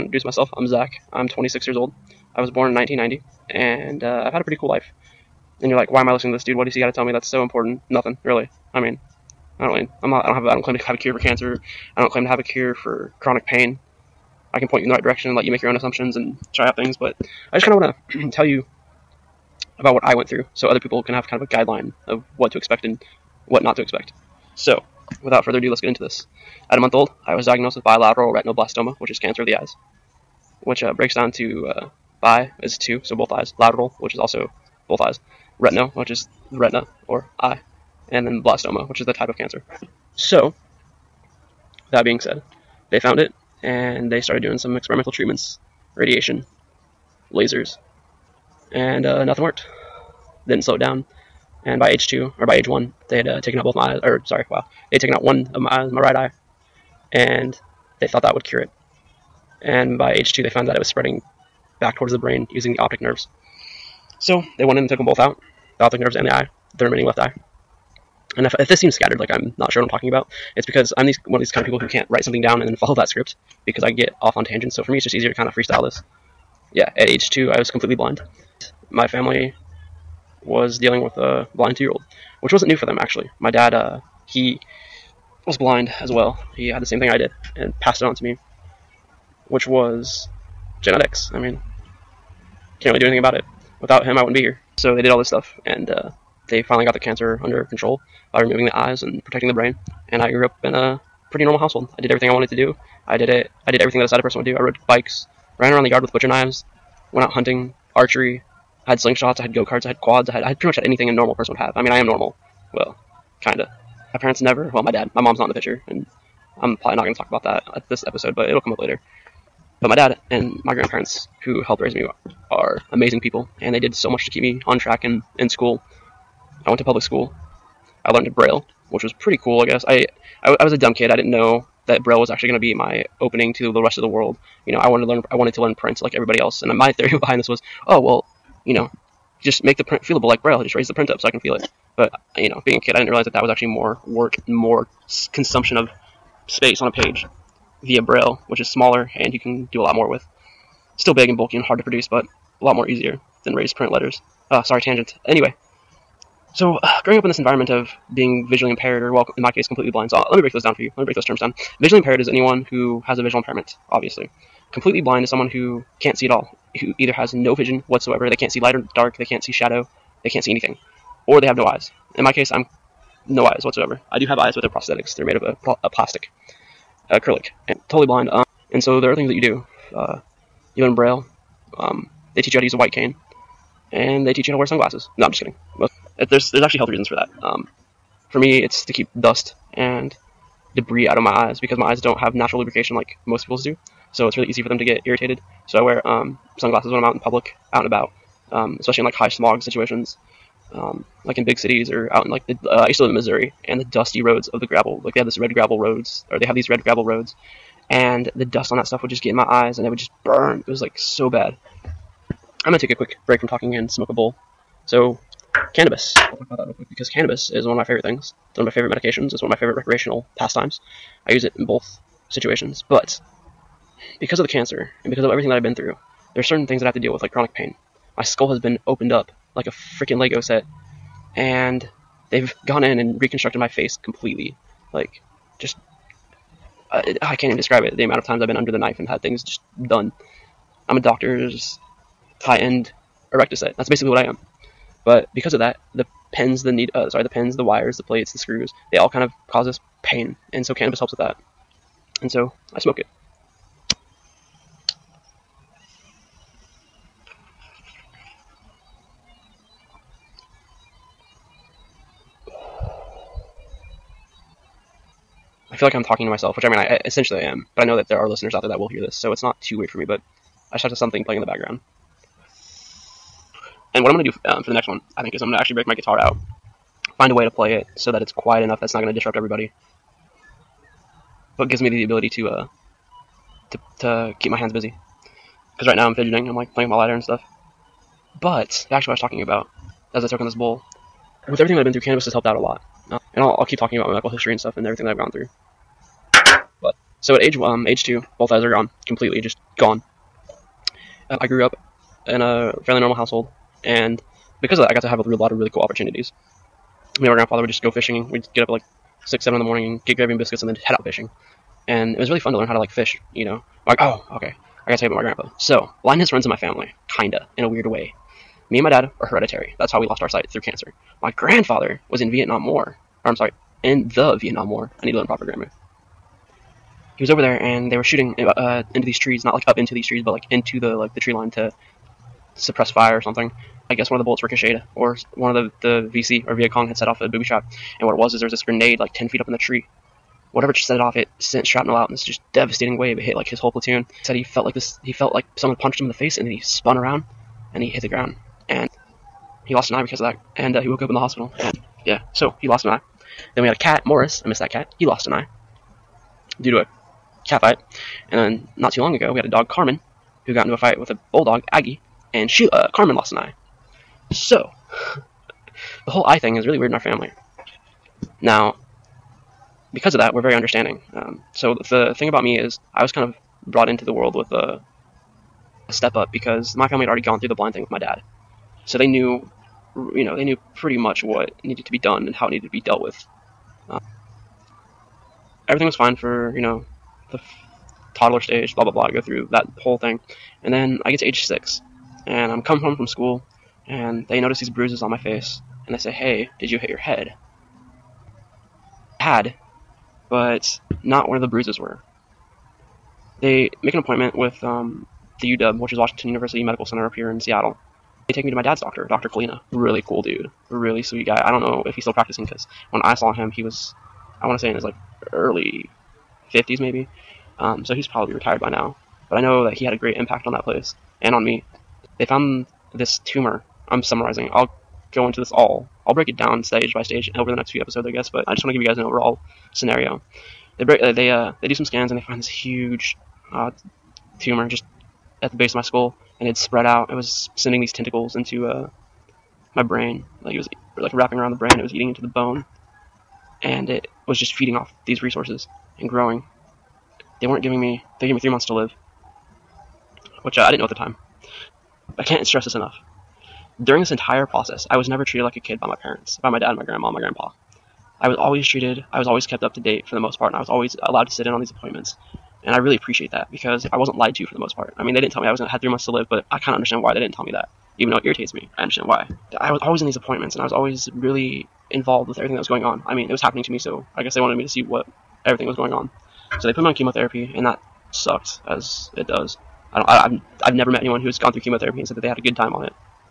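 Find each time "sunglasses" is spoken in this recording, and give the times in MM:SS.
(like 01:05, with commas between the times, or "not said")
03:04, 03:16.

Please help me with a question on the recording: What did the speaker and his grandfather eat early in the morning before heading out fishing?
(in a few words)
Gravy and biscuits.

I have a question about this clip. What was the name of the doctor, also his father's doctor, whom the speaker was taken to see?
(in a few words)
Dr. Kalina.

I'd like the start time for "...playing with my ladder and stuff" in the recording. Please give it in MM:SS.
04:46.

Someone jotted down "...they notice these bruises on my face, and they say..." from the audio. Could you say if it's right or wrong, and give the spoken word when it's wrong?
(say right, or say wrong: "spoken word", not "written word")
right.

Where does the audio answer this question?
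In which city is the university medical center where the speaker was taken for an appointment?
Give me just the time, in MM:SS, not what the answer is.
06:47.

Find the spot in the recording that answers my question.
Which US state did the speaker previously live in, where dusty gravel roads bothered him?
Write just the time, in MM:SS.
03:23.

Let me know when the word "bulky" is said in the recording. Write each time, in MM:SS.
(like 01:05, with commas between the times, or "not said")
02:31.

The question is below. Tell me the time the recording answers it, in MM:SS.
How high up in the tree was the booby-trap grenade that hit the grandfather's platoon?
05:39.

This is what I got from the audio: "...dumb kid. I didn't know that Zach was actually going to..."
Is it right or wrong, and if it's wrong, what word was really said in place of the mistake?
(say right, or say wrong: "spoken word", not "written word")
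wrong: "Braille", not "Zach".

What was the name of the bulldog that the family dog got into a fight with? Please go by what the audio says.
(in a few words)
Aggie.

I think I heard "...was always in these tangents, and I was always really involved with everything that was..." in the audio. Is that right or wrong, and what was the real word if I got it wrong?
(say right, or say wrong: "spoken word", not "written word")
wrong: "appointments", not "tangents".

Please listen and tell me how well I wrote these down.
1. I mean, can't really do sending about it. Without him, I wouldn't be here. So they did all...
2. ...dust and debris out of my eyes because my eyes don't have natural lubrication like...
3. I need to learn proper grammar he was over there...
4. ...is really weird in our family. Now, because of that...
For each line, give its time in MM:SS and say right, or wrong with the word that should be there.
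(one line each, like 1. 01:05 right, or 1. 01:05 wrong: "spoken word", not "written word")
1. 01:31 wrong: "anything", not "sending"
2. 03:09 right
3. 05:25 right
4. 06:06 right.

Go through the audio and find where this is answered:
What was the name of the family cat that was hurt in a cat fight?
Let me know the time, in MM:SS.
05:54.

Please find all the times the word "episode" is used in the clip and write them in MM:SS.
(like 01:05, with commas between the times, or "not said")
01:58, 07:07.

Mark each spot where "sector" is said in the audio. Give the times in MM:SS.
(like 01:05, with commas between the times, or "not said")
not said.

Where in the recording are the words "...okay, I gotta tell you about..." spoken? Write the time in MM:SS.
05:14.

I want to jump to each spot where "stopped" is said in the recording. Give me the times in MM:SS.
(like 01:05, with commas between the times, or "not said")
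not said.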